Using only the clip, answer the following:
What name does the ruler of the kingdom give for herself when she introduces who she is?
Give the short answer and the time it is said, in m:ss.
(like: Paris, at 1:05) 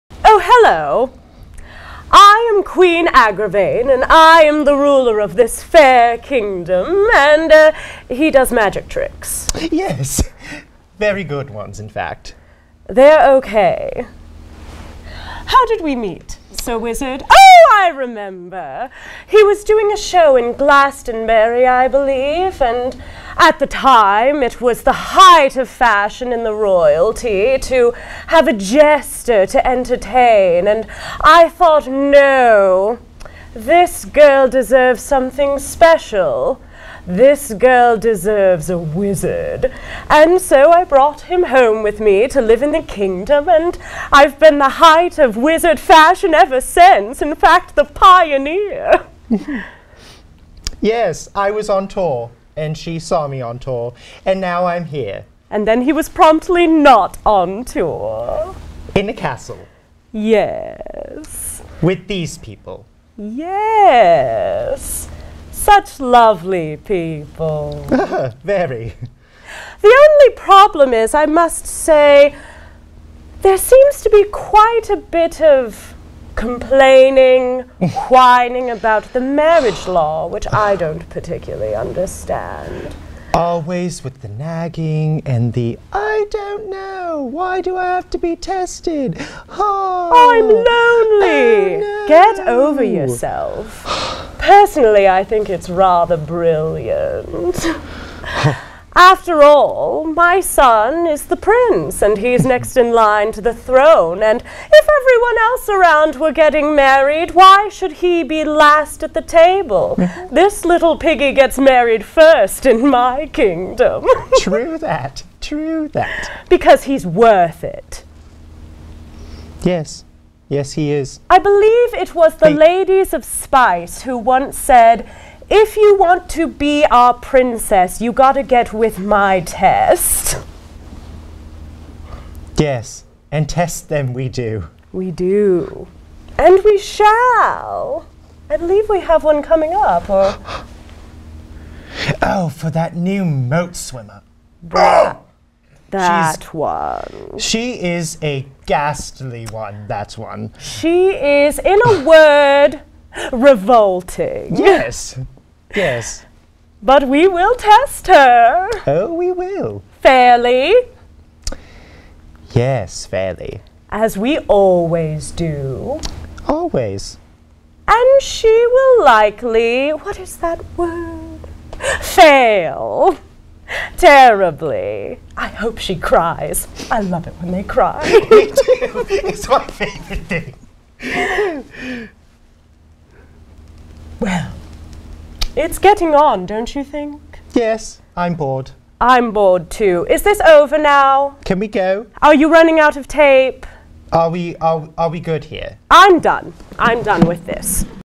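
Queen Aggravain, at 0:02.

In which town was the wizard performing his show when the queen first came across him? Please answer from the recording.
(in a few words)
Glastonbury.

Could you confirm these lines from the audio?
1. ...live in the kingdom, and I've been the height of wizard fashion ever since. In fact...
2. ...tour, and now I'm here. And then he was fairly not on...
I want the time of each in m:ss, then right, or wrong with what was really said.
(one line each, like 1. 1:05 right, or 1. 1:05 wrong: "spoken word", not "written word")
1. 0:42 right
2. 0:53 wrong: "promptly", not "fairly".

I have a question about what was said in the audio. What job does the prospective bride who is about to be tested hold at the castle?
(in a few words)
Moat swimmer.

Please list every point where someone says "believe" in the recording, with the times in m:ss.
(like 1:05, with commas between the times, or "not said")
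0:21, 2:01, 2:18.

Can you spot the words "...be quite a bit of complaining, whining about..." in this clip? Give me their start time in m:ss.
1:14.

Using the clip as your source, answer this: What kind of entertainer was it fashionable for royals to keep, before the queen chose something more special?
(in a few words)
A jester.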